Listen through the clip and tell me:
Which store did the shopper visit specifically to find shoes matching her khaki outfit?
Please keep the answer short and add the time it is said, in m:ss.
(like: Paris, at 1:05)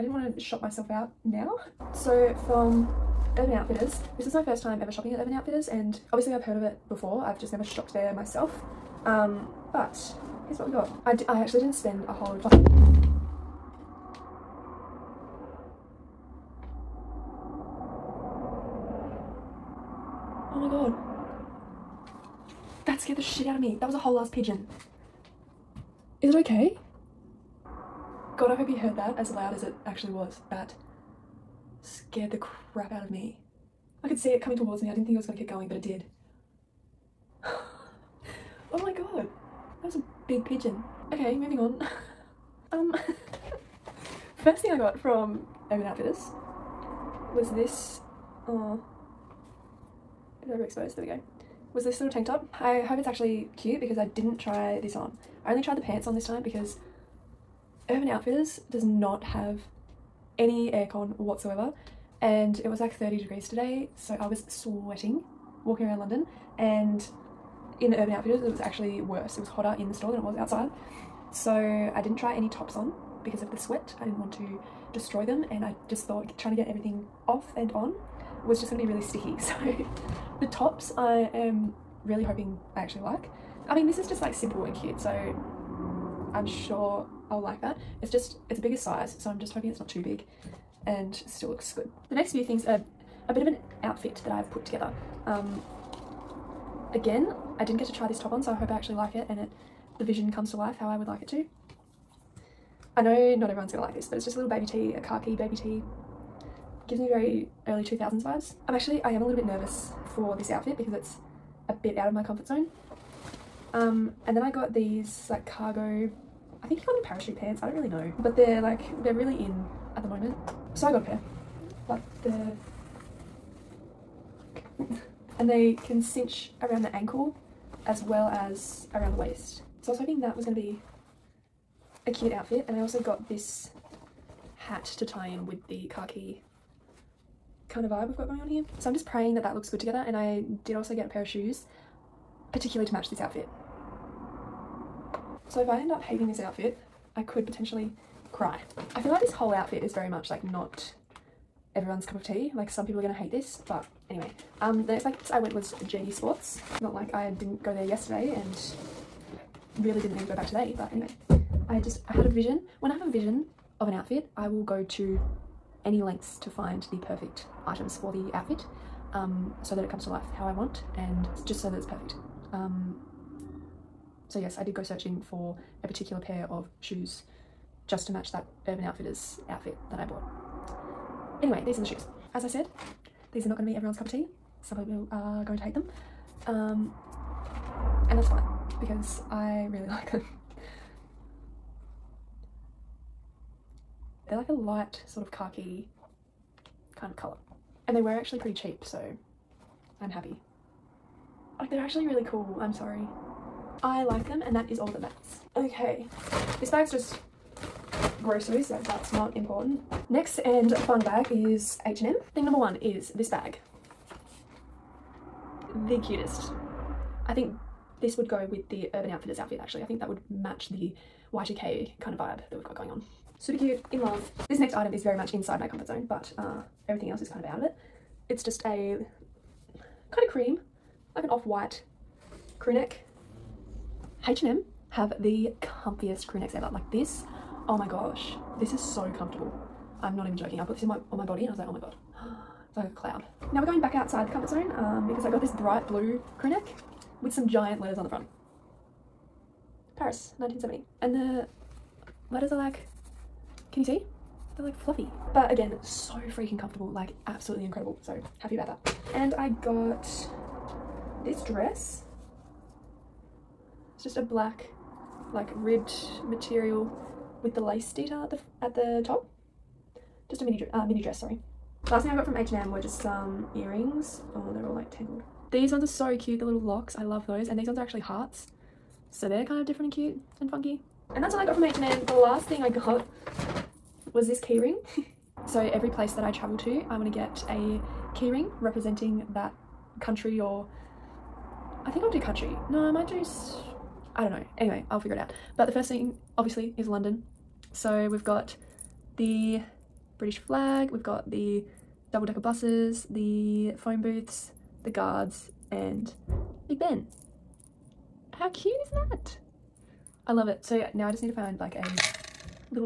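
JD Sports, at 2:35.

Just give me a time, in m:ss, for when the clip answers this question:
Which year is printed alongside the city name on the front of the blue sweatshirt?
4:10.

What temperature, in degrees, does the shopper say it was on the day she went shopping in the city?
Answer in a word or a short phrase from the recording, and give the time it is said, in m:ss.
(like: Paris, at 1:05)
30, at 1:02.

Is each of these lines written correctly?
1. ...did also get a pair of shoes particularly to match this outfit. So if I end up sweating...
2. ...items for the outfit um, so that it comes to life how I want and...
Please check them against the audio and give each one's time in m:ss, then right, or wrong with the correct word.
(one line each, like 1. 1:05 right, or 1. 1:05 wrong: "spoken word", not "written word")
1. 2:20 wrong: "hating", not "sweating"
2. 2:47 right.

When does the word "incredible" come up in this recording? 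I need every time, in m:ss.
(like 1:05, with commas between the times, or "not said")
4:17.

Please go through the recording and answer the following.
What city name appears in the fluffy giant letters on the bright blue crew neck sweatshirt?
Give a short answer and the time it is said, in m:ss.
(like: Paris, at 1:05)
Paris, at 4:09.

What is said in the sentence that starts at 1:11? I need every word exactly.
So I didn't try any tops on because of the sweat.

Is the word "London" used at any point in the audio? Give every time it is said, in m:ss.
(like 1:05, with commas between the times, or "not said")
1:05, 4:56.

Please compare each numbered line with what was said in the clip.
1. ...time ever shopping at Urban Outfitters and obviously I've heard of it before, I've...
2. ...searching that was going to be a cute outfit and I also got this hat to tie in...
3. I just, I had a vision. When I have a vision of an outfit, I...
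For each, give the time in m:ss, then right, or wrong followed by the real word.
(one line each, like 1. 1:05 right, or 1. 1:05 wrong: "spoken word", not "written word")
1. 0:04 right
2. 2:09 wrong: "hoping", not "searching"
3. 2:41 right.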